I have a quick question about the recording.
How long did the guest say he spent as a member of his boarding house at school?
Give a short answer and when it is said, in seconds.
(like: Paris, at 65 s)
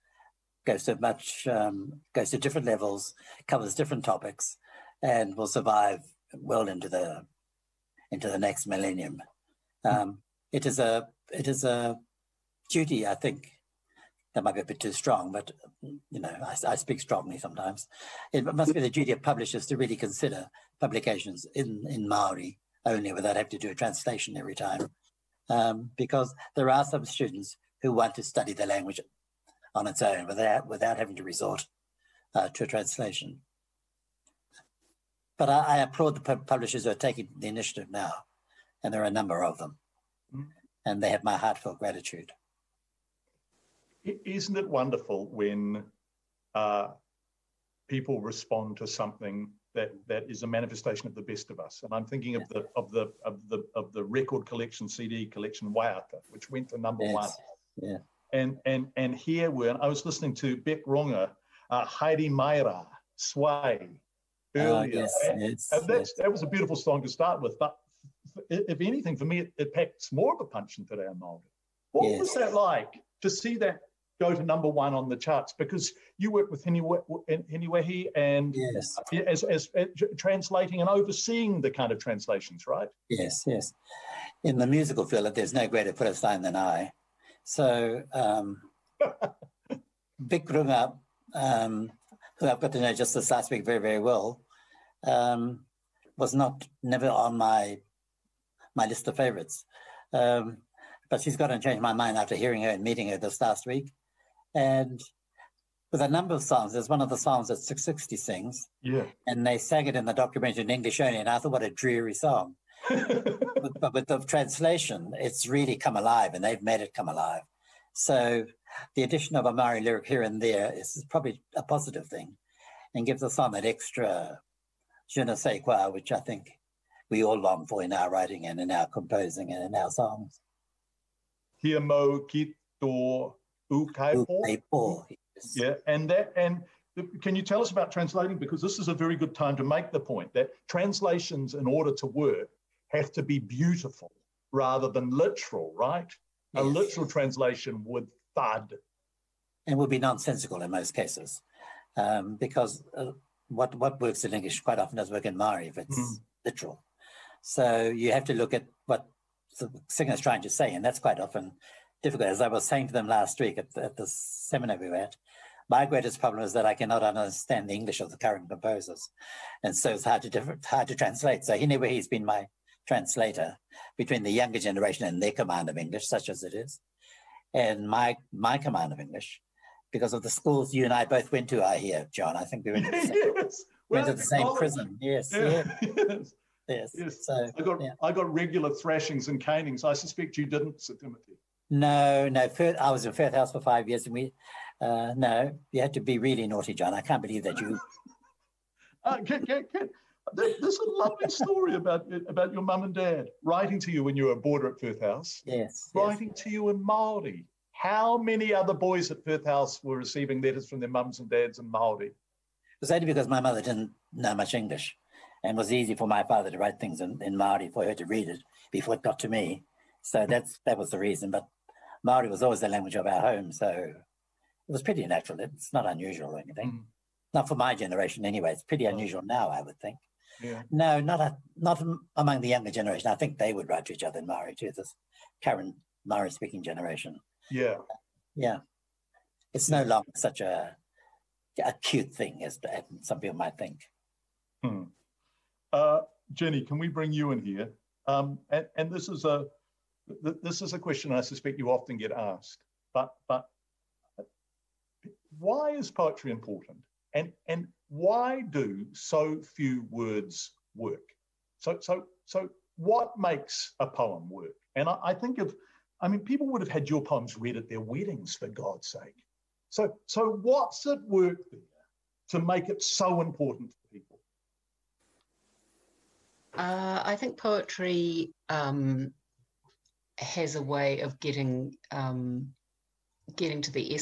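5 years, at 193 s.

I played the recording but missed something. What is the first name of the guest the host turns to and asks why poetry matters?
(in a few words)
Jenny.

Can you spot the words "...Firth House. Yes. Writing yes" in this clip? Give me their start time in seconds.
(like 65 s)
204 s.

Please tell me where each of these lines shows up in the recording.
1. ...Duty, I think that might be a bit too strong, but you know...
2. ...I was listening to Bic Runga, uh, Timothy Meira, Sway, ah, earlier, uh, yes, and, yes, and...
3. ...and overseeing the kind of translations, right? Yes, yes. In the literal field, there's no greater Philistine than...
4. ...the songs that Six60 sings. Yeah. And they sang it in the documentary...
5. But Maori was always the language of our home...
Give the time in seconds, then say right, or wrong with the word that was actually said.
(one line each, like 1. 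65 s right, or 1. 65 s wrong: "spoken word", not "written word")
1. 12 s right
2. 59 s wrong: "Heidi", not "Timothy"
3. 80 s wrong: "musical", not "literal"
4. 107 s right
5. 221 s right.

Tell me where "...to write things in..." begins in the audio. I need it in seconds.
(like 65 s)
216 s.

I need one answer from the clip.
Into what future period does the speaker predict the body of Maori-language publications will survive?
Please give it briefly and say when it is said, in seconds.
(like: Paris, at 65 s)
the next millennium, at 8 s.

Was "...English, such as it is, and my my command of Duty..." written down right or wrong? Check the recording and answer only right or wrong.
wrong.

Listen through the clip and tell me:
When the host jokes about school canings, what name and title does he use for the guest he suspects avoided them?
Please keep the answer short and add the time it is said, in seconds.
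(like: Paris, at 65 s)
Sir Timothy, at 190 s.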